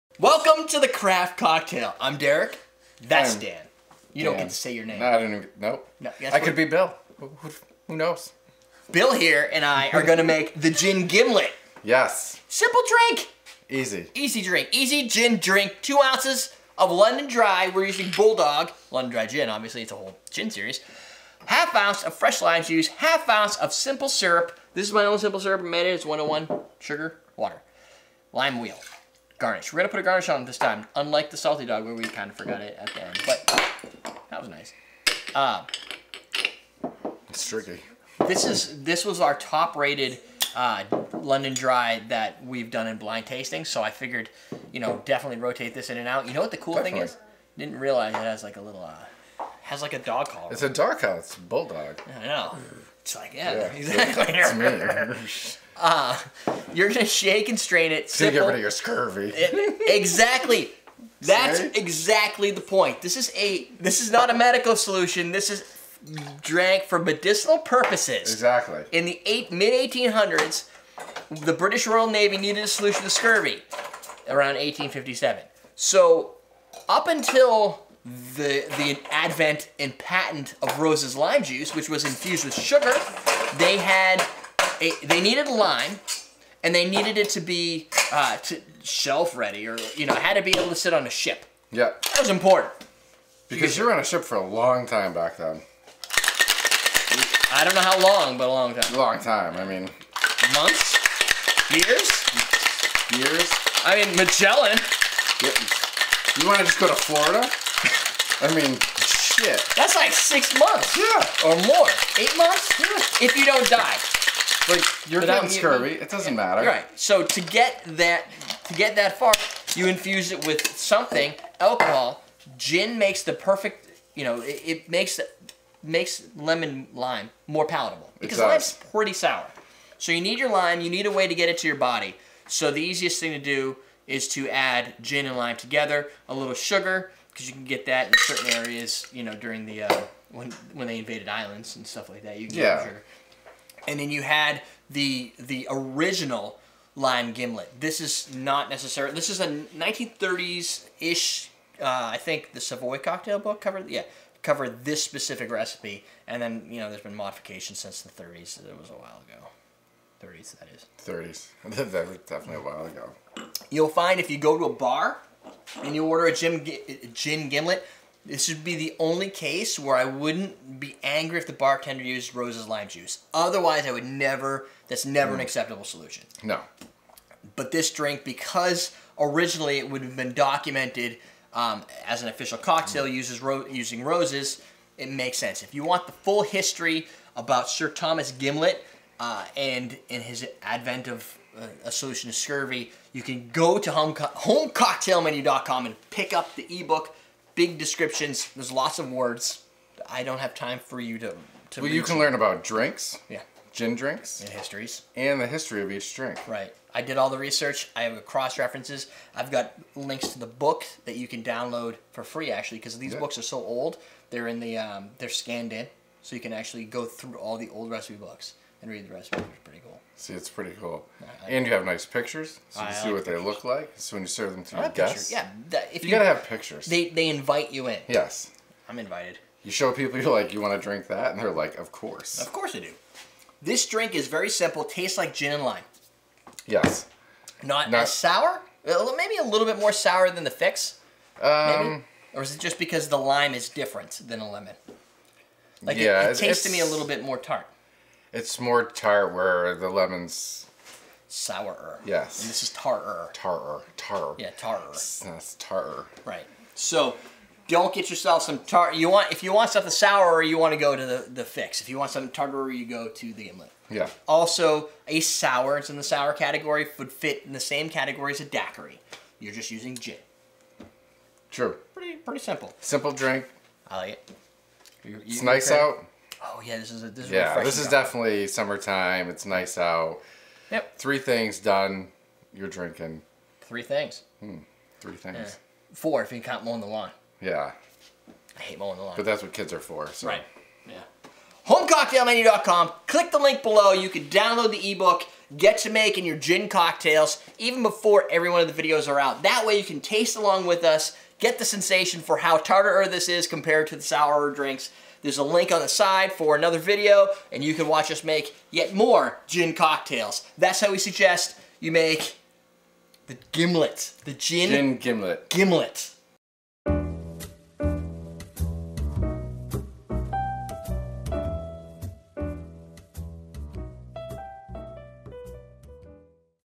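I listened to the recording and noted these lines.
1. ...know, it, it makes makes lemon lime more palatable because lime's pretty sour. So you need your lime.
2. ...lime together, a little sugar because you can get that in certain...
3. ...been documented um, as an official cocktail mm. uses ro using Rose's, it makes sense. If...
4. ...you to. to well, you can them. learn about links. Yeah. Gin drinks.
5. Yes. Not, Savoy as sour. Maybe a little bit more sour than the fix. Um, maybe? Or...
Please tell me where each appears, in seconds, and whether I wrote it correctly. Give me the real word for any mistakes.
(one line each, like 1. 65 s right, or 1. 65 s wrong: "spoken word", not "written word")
1. 124 s right
2. 135 s right
3. 180 s right
4. 200 s wrong: "drinks", not "links"
5. 236 s wrong: "Not", not "Savoy".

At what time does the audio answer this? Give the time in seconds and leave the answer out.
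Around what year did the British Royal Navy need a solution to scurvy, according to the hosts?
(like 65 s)
74 s.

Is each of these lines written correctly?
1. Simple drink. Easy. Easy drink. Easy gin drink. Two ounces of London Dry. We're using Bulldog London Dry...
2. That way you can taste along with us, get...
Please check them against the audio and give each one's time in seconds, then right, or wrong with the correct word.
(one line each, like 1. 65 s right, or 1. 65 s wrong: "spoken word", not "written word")
1. 12 s right
2. 299 s right.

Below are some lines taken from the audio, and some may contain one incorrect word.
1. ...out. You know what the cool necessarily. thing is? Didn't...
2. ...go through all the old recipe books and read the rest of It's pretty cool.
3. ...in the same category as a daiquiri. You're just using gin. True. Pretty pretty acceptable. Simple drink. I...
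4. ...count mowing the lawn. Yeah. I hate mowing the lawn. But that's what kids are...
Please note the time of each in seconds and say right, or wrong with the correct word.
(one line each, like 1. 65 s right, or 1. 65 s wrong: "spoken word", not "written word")
1. 46 s wrong: "definitely", not "necessarily"
2. 216 s right
3. 267 s wrong: "simple", not "acceptable"
4. 286 s right.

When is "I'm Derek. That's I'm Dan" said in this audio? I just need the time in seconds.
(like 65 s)
1 s.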